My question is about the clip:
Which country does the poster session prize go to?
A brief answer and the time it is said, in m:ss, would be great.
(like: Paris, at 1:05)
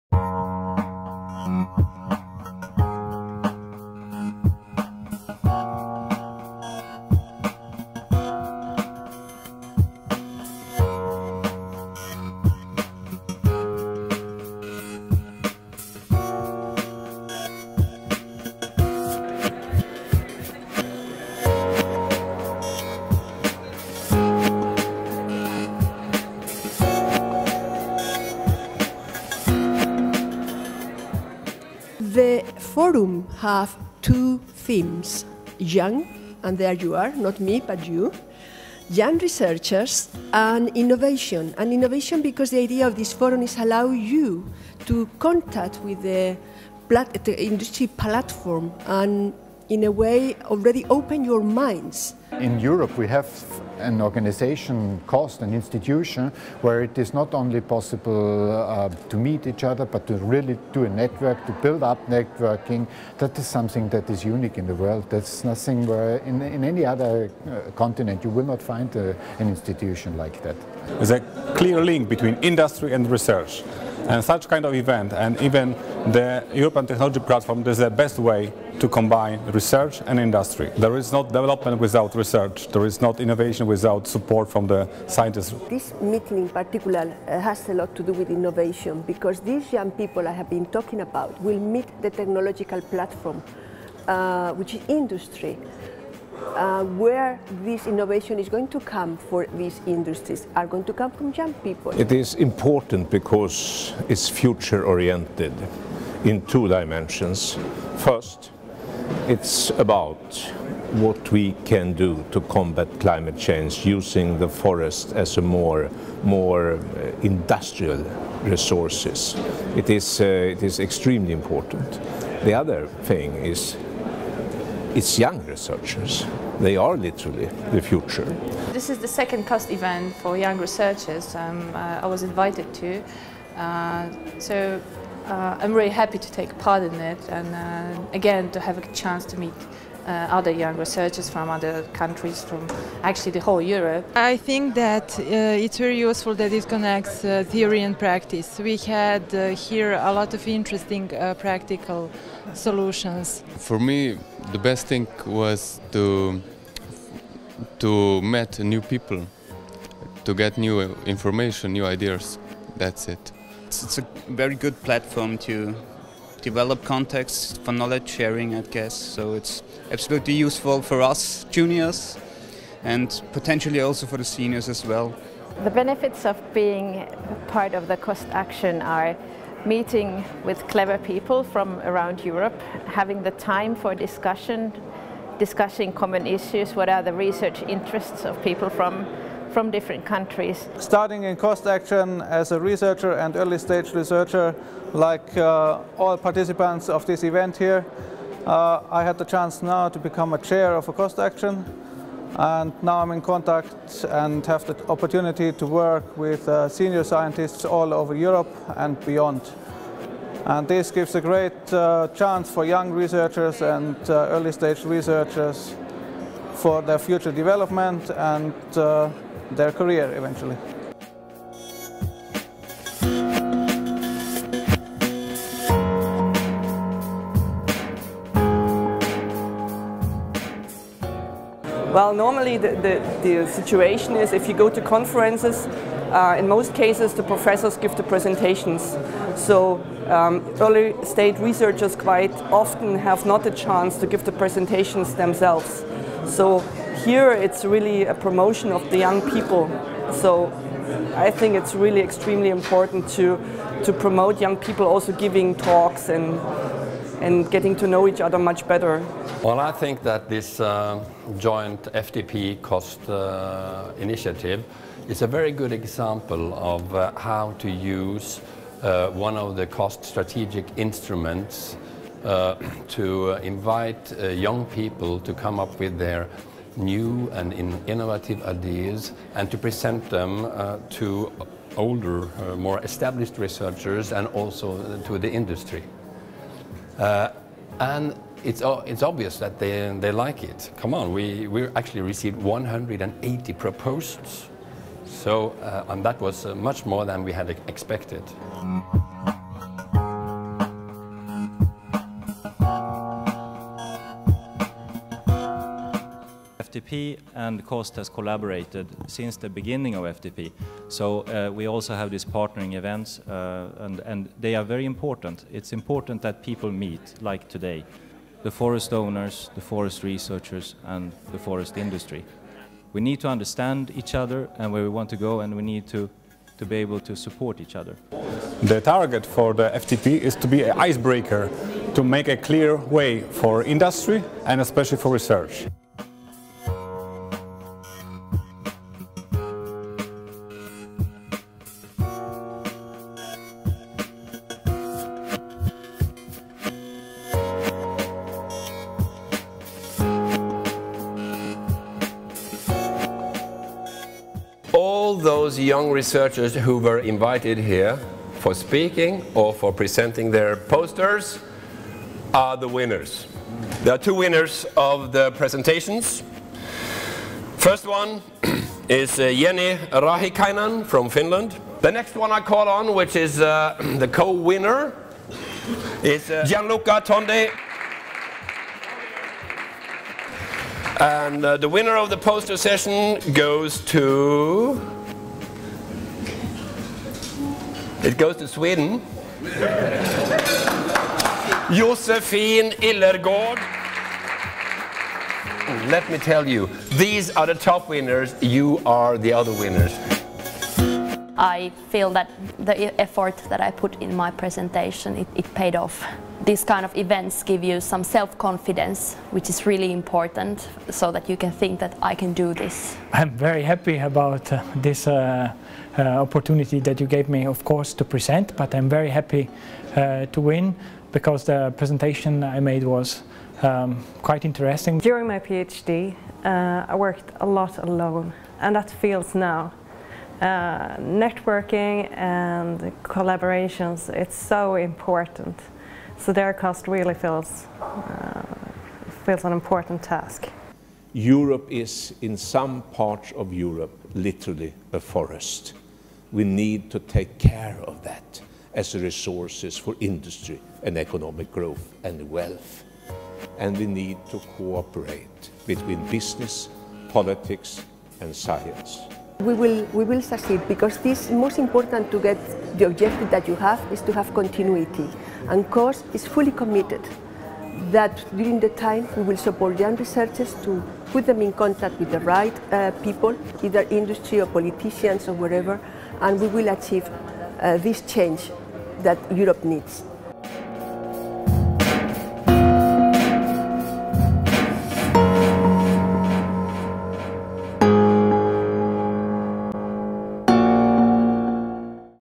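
Sweden, at 6:28.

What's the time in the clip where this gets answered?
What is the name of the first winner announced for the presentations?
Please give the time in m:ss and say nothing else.
6:09.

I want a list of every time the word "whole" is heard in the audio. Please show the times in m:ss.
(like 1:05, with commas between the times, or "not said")
2:23.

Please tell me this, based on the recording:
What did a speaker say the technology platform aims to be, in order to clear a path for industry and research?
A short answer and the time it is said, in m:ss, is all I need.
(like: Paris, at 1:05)
an icebreaker, at 5:30.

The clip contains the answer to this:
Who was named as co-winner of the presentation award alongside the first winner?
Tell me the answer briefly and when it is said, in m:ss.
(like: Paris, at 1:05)
Gianluca Tonde, at 6:16.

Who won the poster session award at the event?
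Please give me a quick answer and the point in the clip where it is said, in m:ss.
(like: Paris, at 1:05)
Josefin Illergård, at 6:31.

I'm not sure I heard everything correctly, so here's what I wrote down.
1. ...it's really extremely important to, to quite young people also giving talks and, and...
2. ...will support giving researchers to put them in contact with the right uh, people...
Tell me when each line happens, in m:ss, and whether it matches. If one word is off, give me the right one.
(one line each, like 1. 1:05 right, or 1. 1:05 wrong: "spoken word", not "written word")
1. 4:11 wrong: "promote", not "quite"
2. 7:49 wrong: "young", not "giving".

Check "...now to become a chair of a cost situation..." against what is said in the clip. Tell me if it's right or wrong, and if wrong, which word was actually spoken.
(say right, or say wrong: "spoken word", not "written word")
wrong: "action", not "situation".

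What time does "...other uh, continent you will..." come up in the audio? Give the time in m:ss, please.
1:06.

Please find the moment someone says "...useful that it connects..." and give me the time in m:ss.
2:25.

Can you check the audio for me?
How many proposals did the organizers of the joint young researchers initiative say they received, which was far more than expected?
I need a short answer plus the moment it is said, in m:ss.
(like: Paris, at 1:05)
180, at 4:52.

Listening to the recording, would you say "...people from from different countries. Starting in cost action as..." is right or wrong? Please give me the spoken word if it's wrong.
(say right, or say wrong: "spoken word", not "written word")
right.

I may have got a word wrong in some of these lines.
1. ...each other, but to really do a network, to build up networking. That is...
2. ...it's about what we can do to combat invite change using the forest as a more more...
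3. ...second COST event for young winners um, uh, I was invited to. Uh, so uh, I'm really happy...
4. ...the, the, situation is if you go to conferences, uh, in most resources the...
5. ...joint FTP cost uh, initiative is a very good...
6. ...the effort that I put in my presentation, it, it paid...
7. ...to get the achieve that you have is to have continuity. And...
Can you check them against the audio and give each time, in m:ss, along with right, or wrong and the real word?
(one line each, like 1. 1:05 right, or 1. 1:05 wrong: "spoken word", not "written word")
1. 0:59 right
2. 1:49 wrong: "climate", not "invite"
3. 2:09 wrong: "researchers", not "winners"
4. 3:52 wrong: "cases", not "resources"
5. 4:21 right
6. 6:42 right
7. 7:42 wrong: "objective", not "achieve".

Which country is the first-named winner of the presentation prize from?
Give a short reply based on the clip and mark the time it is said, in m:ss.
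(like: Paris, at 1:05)
Finland, at 6:11.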